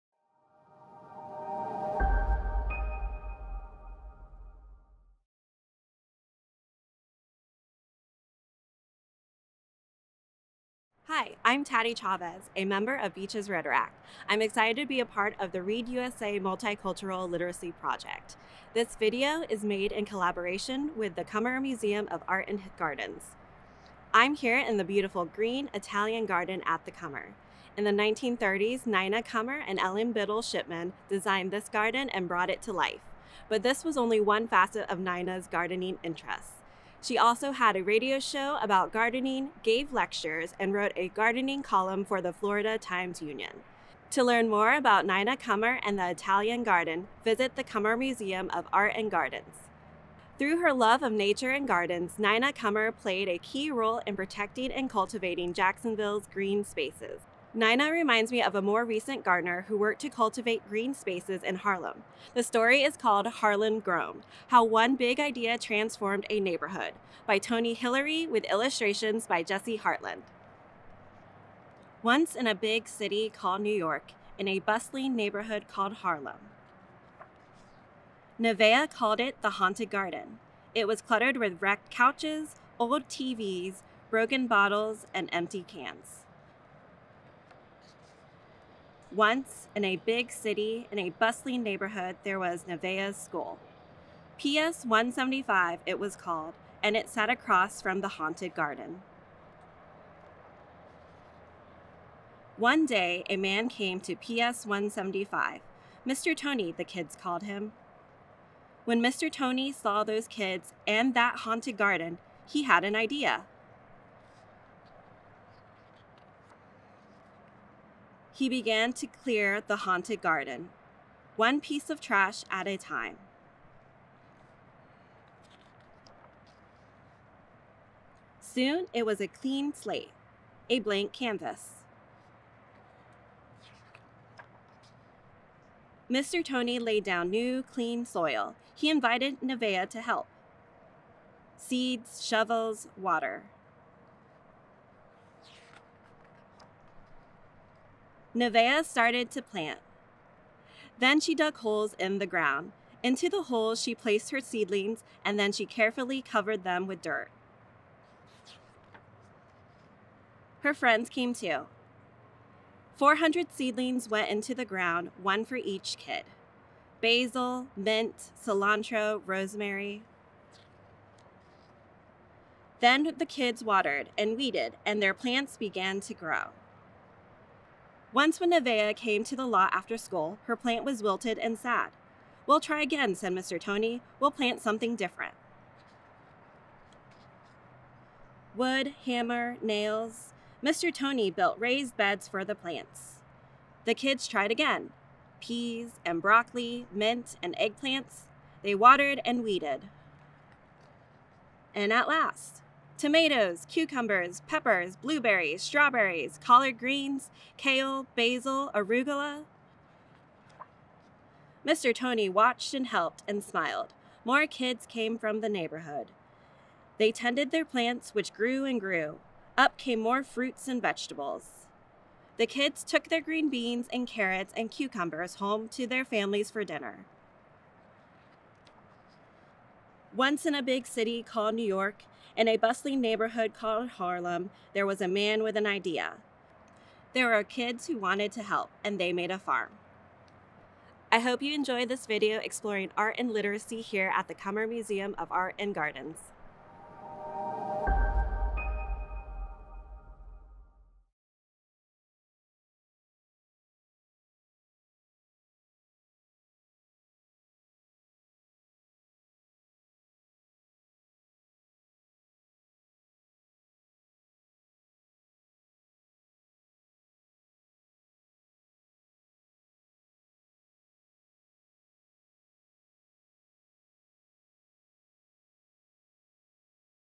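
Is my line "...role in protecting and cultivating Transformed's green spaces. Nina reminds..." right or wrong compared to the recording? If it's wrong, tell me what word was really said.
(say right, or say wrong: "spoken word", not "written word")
wrong: "Jacksonville", not "Transformed".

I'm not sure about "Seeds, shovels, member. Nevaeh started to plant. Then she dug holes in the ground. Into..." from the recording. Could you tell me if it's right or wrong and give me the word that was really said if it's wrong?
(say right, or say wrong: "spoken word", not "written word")
wrong: "water", not "member".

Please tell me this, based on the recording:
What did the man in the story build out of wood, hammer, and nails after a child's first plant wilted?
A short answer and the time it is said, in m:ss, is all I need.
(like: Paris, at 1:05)
Raised beds, at 3:11.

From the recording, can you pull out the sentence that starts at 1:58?
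he began to clear the haunted garden, one piece of trash at a time.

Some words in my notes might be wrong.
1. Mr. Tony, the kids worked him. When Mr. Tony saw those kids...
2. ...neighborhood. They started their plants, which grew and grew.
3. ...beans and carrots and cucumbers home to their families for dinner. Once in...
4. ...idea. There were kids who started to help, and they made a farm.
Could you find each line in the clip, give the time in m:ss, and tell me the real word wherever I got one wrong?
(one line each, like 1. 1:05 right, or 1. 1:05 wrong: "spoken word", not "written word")
1. 1:46 wrong: "called", not "worked"
2. 3:35 wrong: "tended", not "started"
3. 3:43 right
4. 3:55 wrong: "wanted", not "started".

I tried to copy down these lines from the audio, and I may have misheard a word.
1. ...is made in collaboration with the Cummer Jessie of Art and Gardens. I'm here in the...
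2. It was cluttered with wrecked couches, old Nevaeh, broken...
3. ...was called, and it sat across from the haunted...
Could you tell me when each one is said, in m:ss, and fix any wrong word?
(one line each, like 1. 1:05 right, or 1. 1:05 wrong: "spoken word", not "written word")
1. 0:19 wrong: "Museum", not "Jessie"
2. 1:20 wrong: "TVs", not "Nevaeh"
3. 1:35 right.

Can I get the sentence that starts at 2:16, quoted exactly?
Tony laid down new, clean soil.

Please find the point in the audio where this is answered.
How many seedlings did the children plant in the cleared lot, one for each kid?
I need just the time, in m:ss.
2:42.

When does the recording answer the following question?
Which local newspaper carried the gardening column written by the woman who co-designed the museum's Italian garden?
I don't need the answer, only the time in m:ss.
0:42.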